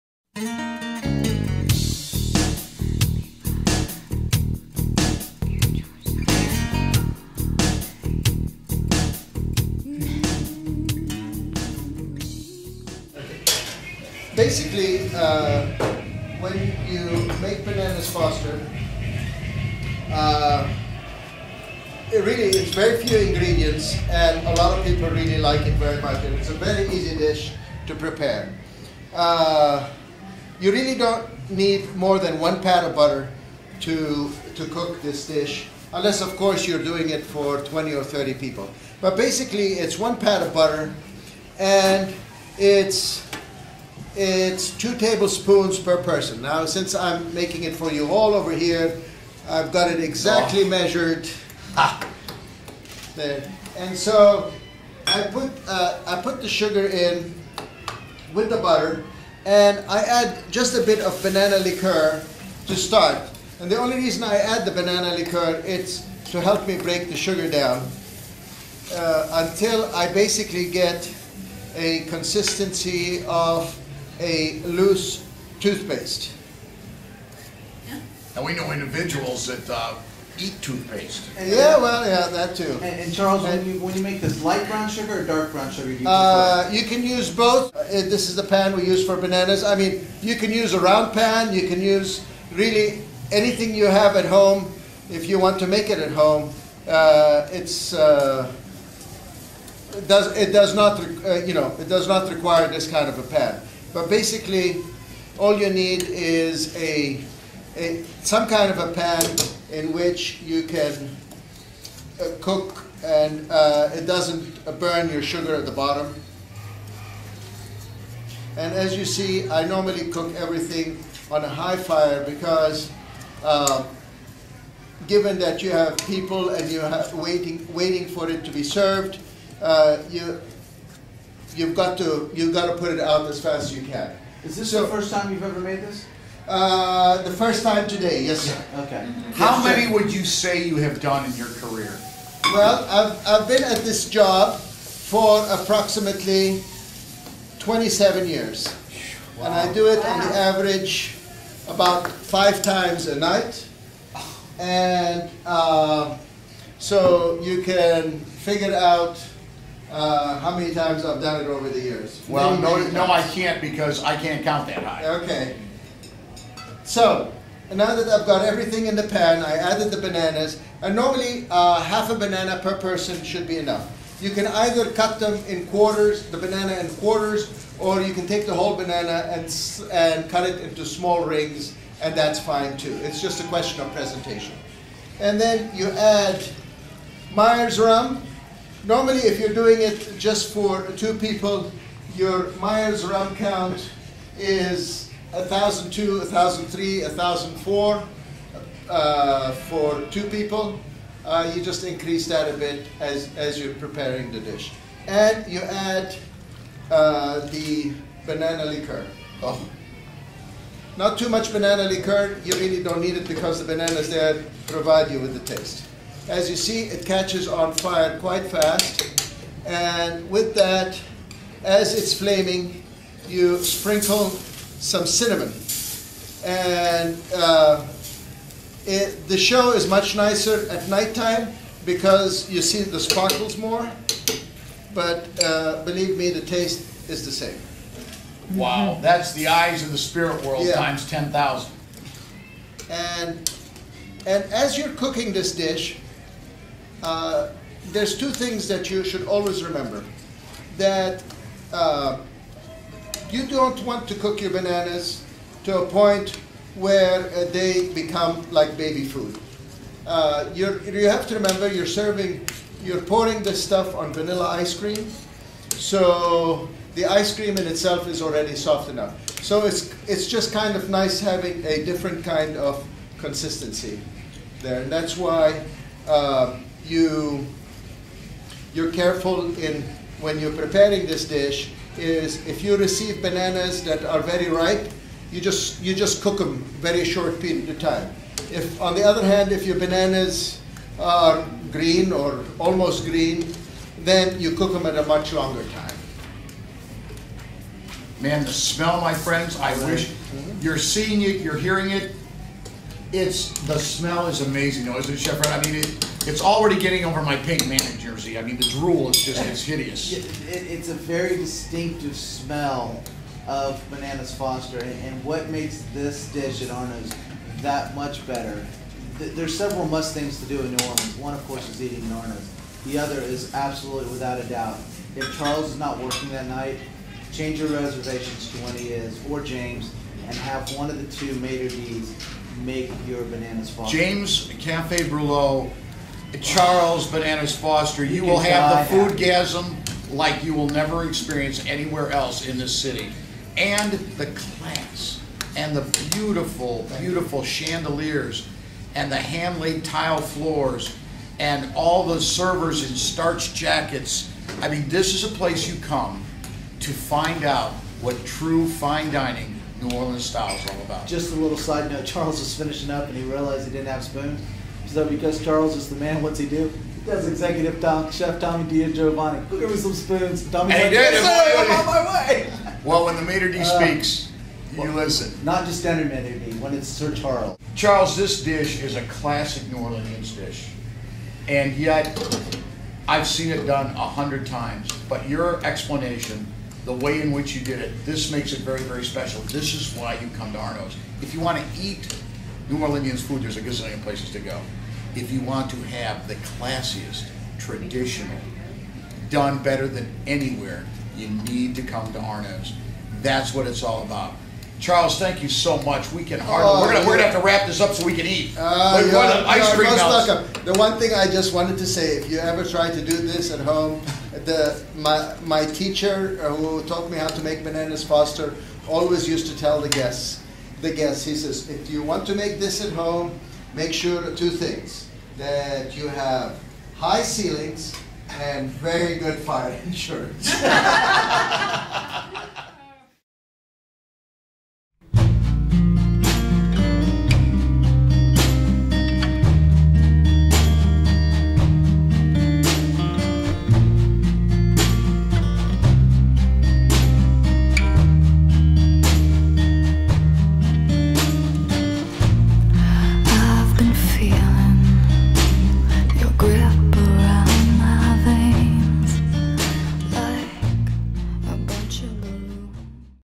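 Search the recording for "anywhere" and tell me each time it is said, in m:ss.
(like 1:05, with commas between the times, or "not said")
5:41, 6:40.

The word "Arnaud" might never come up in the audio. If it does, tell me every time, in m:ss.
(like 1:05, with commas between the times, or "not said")
5:16, 5:22, 6:30, 6:42.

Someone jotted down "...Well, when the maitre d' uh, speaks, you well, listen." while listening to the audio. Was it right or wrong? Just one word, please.
right.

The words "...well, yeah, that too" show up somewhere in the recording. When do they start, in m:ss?
1:21.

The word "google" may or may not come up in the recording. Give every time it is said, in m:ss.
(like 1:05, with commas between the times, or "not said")
not said.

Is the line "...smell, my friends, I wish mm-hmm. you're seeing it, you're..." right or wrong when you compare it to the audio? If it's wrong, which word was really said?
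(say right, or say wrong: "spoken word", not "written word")
right.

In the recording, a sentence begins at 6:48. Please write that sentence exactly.
Uh, yeah, ice yeah, cream Welcome.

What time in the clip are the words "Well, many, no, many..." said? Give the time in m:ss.
2:42.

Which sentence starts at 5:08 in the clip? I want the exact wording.
I mean, the drool is just it's hideous.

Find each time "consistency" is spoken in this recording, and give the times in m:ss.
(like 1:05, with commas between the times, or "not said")
1:12, 4:33.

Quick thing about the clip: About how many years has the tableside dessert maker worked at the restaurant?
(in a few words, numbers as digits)
27.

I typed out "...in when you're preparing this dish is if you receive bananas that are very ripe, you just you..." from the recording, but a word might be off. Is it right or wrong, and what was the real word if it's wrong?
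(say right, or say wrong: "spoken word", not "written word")
right.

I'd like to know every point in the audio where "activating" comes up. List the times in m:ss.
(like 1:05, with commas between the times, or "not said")
not said.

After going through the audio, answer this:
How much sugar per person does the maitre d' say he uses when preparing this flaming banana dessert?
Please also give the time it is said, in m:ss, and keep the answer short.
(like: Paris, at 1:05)
2 tablespoons, at 0:44.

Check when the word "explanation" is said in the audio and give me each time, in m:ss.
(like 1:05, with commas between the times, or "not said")
6:25.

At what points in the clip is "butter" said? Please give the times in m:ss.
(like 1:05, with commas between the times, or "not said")
0:32, 0:40, 0:58.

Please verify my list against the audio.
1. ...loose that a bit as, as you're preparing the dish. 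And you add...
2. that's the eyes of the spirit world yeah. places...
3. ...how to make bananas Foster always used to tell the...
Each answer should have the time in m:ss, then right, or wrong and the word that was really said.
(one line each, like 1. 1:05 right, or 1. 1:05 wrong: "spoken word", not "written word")
1. 3:21 wrong: "increase", not "loose"
2. 3:59 wrong: "times", not "places"
3. 6:57 right.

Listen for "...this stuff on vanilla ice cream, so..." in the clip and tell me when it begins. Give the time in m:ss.
4:23.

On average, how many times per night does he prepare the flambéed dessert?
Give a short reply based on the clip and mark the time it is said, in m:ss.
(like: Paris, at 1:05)
5, at 2:32.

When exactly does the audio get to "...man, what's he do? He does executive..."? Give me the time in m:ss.
6:05.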